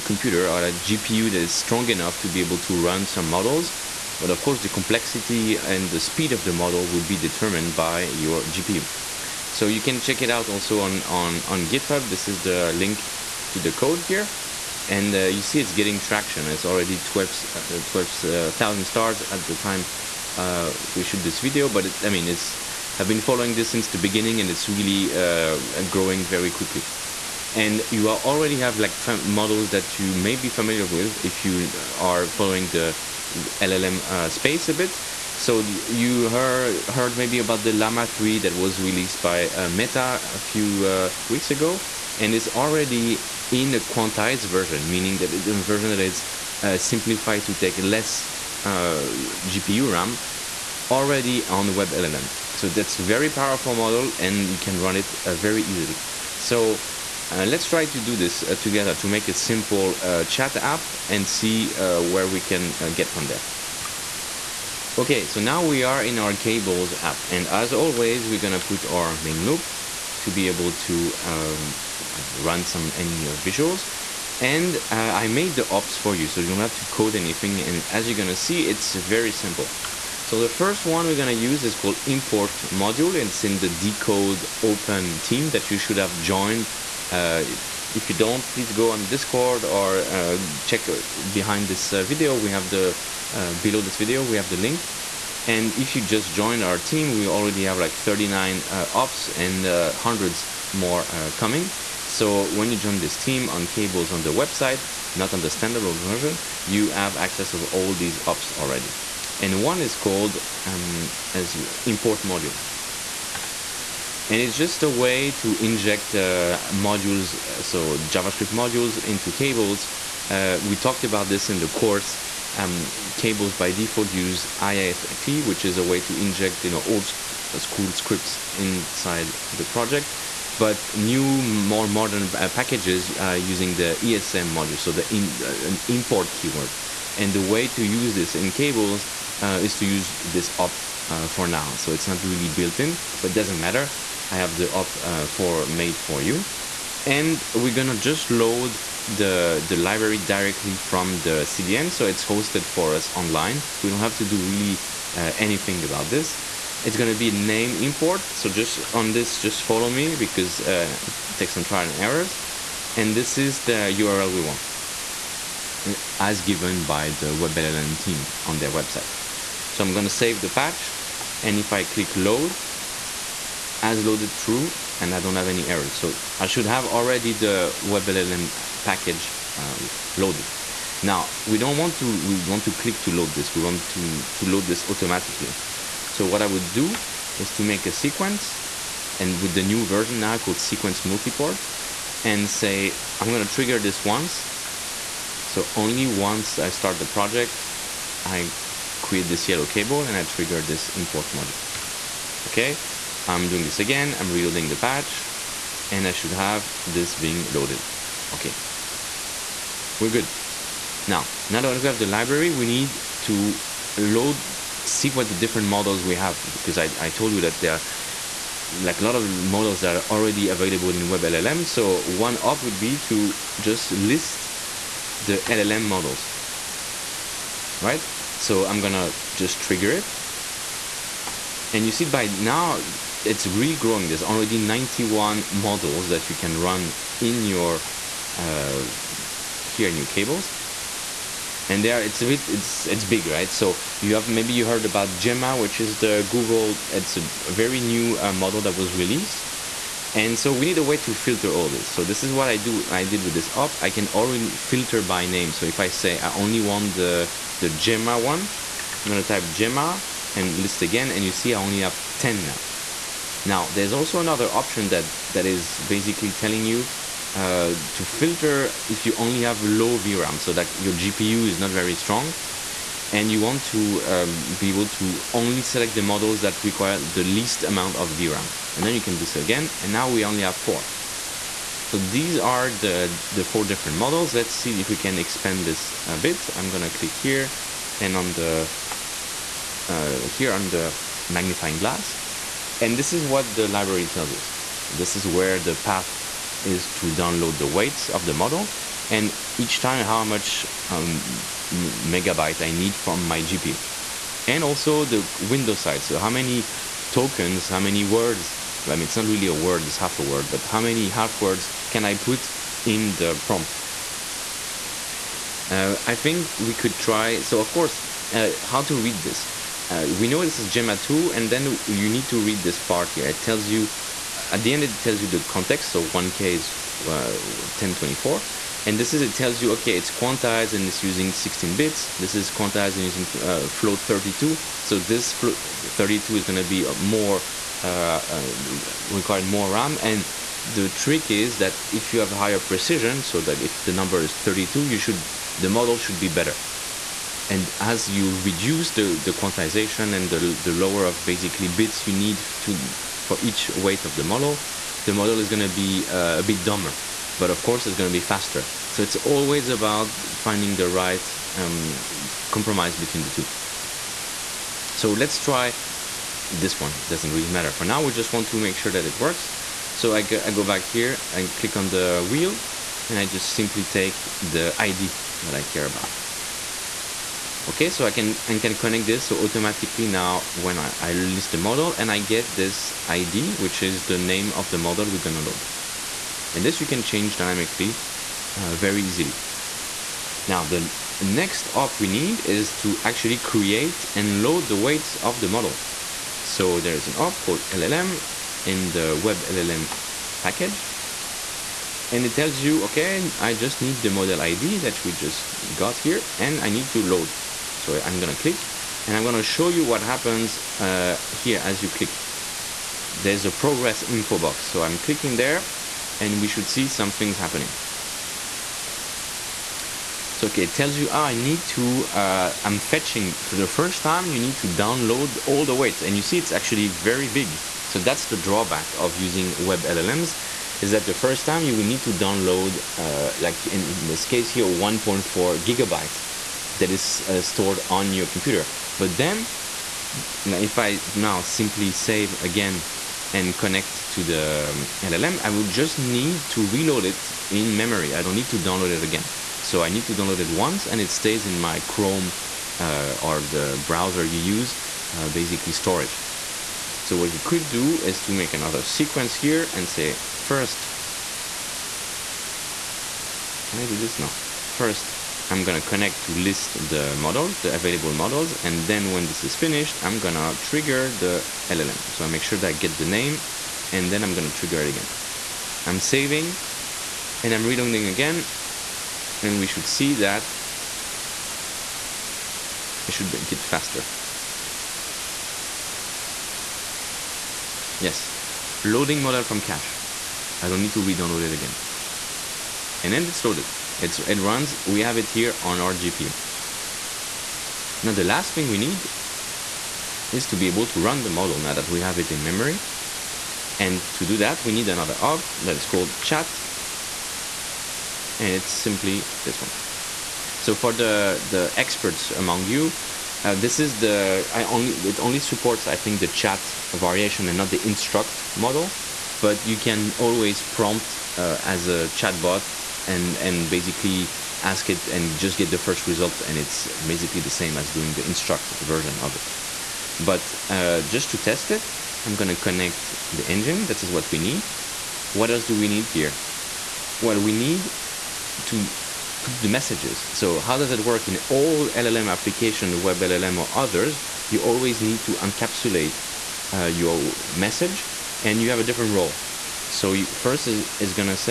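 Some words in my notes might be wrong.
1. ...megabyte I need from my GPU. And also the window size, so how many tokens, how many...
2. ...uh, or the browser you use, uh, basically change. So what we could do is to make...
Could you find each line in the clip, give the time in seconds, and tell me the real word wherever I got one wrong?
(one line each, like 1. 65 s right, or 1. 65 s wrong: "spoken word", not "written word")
1. 301 s right
2. 452 s wrong: "storage", not "change".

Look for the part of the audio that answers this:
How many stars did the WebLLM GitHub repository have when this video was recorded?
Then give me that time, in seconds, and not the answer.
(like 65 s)
16 s.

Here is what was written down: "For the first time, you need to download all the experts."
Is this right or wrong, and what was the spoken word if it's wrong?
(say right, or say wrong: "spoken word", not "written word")
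wrong: "weights", not "experts".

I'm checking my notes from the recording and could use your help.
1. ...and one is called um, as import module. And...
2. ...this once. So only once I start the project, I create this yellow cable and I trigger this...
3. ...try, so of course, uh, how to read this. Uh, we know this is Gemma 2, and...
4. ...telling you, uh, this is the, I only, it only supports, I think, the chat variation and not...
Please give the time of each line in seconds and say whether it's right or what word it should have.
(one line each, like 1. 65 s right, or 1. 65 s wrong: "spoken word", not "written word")
1. 109 s right
2. 193 s right
3. 316 s right
4. 512 s wrong: "among", not "telling".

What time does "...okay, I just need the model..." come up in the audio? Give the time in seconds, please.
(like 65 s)
402 s.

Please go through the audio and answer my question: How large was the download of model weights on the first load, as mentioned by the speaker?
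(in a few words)
1.4 gigabytes.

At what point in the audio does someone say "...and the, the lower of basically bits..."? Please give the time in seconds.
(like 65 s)
350 s.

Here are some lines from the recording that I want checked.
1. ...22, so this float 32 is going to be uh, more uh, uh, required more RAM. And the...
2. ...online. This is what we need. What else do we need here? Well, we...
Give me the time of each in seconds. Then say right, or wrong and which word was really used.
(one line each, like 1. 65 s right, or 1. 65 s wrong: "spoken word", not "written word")
1. 334 s wrong: "32", not "22"
2. 533 s wrong: "engine", not "online".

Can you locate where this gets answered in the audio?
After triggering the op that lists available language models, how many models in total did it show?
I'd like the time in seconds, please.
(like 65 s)
234 s.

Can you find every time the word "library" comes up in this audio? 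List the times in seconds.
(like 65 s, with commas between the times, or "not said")
149 s, 212 s, 293 s.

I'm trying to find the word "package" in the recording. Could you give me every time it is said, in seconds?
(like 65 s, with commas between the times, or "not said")
132 s, 178 s, 400 s.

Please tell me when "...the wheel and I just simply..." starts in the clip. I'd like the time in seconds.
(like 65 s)
371 s.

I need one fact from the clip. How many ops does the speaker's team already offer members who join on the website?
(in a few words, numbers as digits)
39.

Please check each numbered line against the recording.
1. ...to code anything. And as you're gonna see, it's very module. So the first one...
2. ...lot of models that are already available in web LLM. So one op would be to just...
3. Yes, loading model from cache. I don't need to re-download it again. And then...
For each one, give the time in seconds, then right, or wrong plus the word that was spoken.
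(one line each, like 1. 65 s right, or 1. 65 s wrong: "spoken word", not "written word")
1. 76 s wrong: "simple", not "module"
2. 219 s right
3. 488 s right.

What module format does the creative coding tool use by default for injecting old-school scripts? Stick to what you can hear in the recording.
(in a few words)
IIFE.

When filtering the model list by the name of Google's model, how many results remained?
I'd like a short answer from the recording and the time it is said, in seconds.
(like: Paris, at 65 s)
10, at 262 s.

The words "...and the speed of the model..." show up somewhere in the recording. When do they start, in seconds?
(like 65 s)
5 s.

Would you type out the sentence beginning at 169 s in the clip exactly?
So I'm going to save the patch.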